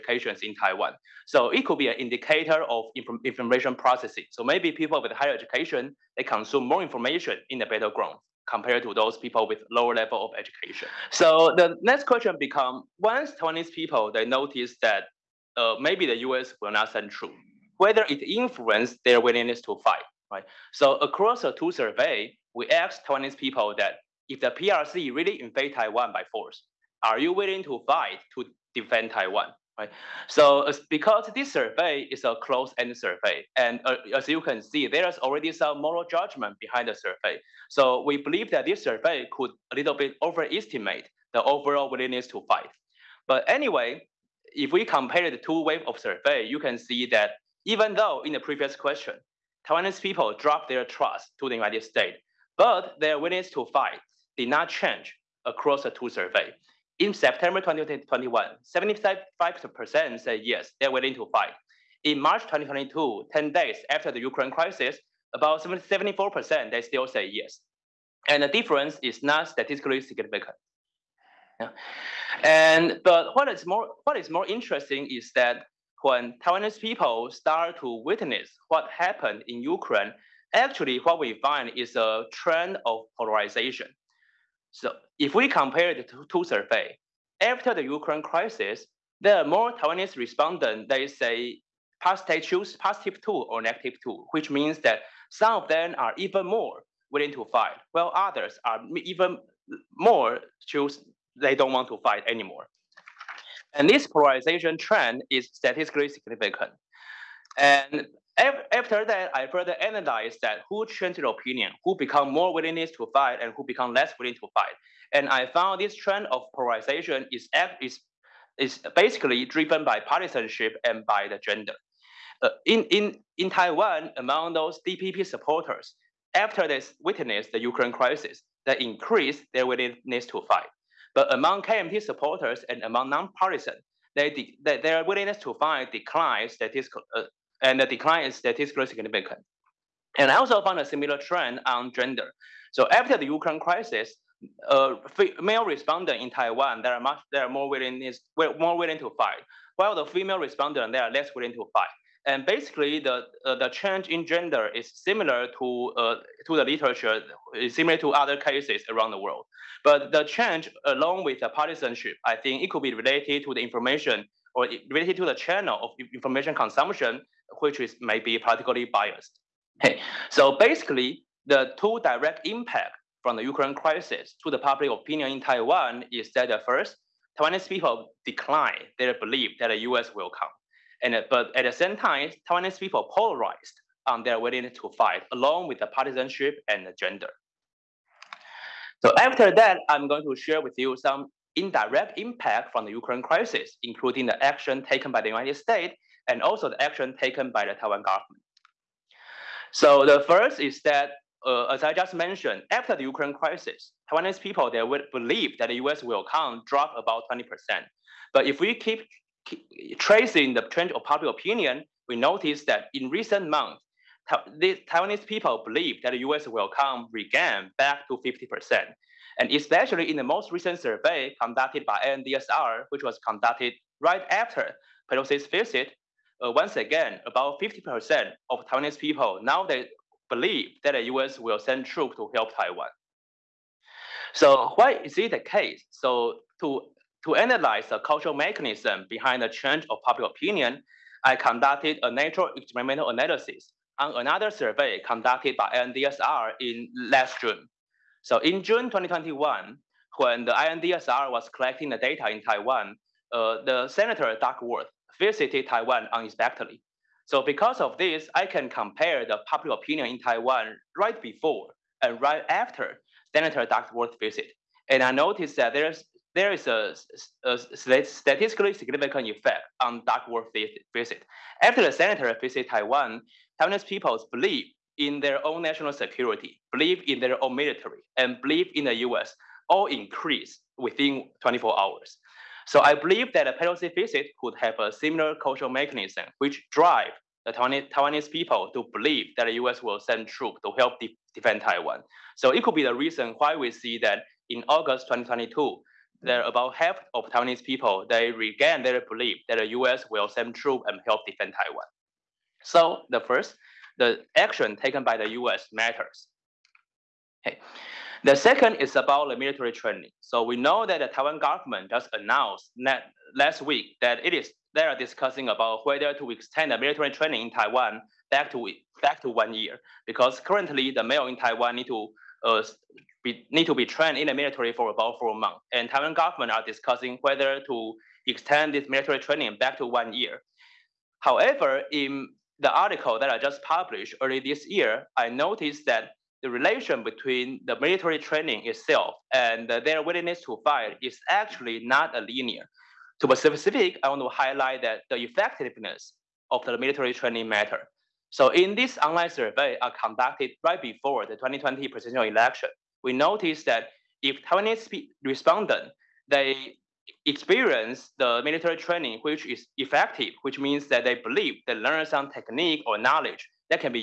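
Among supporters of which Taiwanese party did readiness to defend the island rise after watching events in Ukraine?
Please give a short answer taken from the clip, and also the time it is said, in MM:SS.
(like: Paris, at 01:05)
DPP, at 02:04.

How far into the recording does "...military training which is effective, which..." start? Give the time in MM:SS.
05:58.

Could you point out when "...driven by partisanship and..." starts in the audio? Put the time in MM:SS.
01:59.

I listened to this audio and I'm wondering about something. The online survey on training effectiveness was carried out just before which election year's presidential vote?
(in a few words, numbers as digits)
2020.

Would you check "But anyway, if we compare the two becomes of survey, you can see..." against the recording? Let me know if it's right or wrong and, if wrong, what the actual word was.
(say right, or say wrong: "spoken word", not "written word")
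wrong: "waves", not "becomes".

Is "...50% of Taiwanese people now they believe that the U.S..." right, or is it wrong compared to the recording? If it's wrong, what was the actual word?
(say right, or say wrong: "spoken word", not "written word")
right.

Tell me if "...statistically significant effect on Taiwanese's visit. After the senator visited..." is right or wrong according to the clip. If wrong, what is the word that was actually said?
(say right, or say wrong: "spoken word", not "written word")
wrong: "Duckworth", not "Taiwanese".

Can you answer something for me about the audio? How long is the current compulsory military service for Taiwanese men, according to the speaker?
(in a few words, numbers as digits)
4 months.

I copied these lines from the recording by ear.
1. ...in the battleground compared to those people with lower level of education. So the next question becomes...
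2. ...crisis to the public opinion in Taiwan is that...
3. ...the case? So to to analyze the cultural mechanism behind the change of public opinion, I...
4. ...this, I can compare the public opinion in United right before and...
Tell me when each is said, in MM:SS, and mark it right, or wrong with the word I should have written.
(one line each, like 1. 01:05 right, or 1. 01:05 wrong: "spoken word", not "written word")
1. 00:07 right
2. 02:53 right
3. 03:55 right
4. 04:17 wrong: "Taiwan", not "United".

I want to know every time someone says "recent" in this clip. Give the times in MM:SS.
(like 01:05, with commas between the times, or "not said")
03:33, 03:40.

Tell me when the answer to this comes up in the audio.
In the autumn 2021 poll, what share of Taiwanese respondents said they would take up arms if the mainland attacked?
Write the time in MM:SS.
00:58.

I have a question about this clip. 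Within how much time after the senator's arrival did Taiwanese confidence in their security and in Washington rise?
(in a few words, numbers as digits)
24 hours.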